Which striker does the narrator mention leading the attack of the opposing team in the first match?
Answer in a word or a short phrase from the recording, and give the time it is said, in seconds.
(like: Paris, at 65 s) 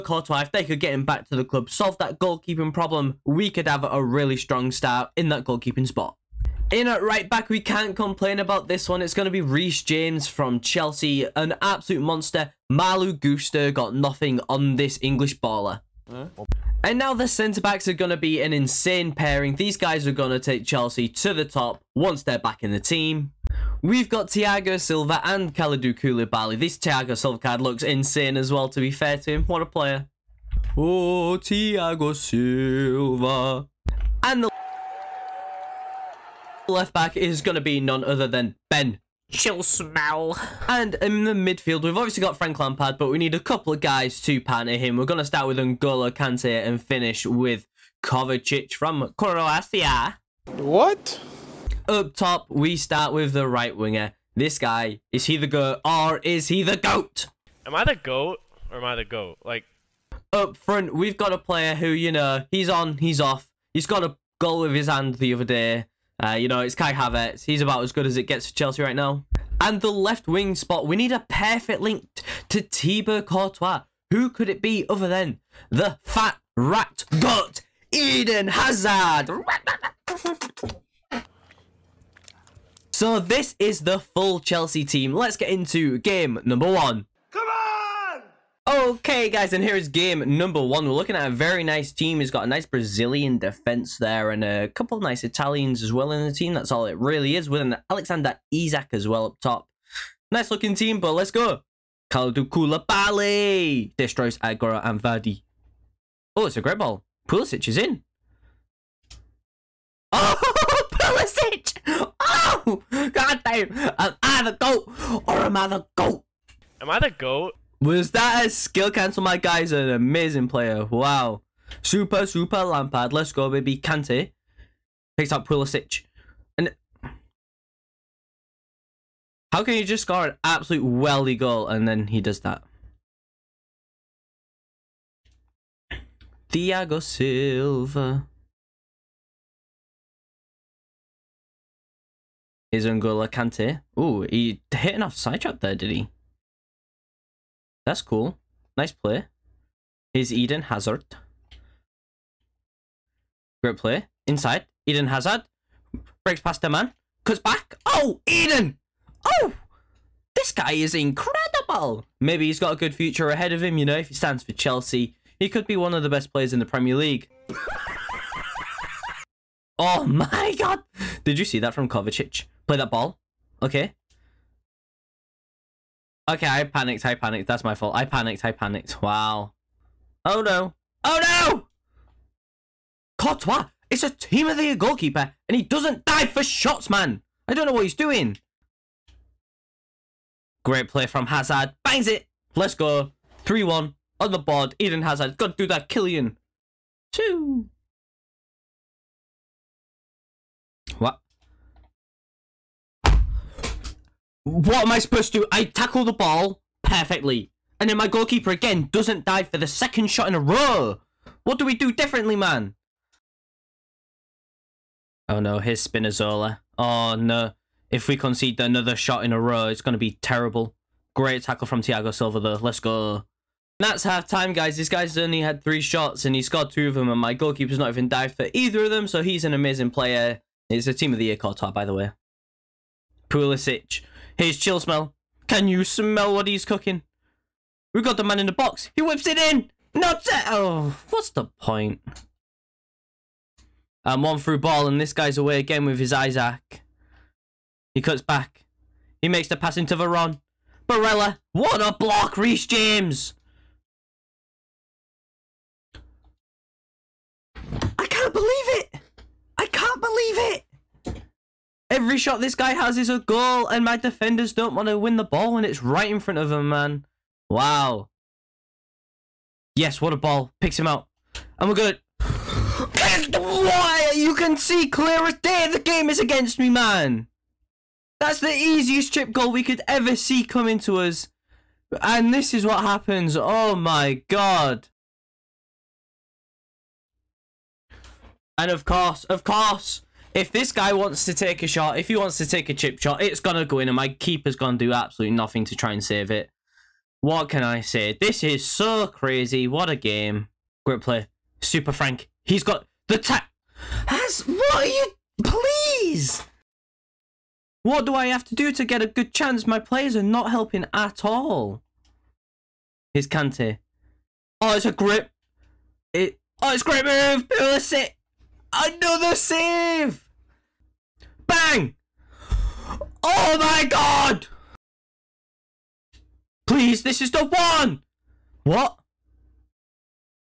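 Alexander Isak, at 97 s.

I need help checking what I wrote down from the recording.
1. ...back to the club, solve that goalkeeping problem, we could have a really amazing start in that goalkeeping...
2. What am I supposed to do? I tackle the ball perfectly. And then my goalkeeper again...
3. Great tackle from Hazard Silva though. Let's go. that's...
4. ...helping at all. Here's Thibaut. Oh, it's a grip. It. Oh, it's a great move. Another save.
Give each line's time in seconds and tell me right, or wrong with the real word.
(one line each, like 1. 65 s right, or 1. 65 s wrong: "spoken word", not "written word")
1. 1 s wrong: "strong", not "amazing"
2. 204 s right
3. 221 s wrong: "Thiago", not "Hazard"
4. 310 s wrong: "Kante", not "Thibaut".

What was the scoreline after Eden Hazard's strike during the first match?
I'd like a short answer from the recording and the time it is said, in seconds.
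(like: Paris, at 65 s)
3-1, at 193 s.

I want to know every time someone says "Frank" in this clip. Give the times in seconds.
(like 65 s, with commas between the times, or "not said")
42 s, 301 s.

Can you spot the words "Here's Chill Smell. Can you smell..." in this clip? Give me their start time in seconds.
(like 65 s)
234 s.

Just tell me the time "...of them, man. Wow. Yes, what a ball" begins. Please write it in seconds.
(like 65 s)
266 s.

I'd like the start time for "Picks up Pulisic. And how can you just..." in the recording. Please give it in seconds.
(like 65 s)
125 s.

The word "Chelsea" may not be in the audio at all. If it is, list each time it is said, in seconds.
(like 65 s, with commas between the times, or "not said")
10 s, 20 s, 68 s, 84 s, 164 s.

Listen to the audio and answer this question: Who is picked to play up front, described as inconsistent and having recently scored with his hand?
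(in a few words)
Kai Havertz.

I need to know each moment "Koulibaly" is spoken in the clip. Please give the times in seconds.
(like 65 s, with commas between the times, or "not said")
25 s, 102 s.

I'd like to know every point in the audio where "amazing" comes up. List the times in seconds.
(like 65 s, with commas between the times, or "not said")
119 s, 229 s.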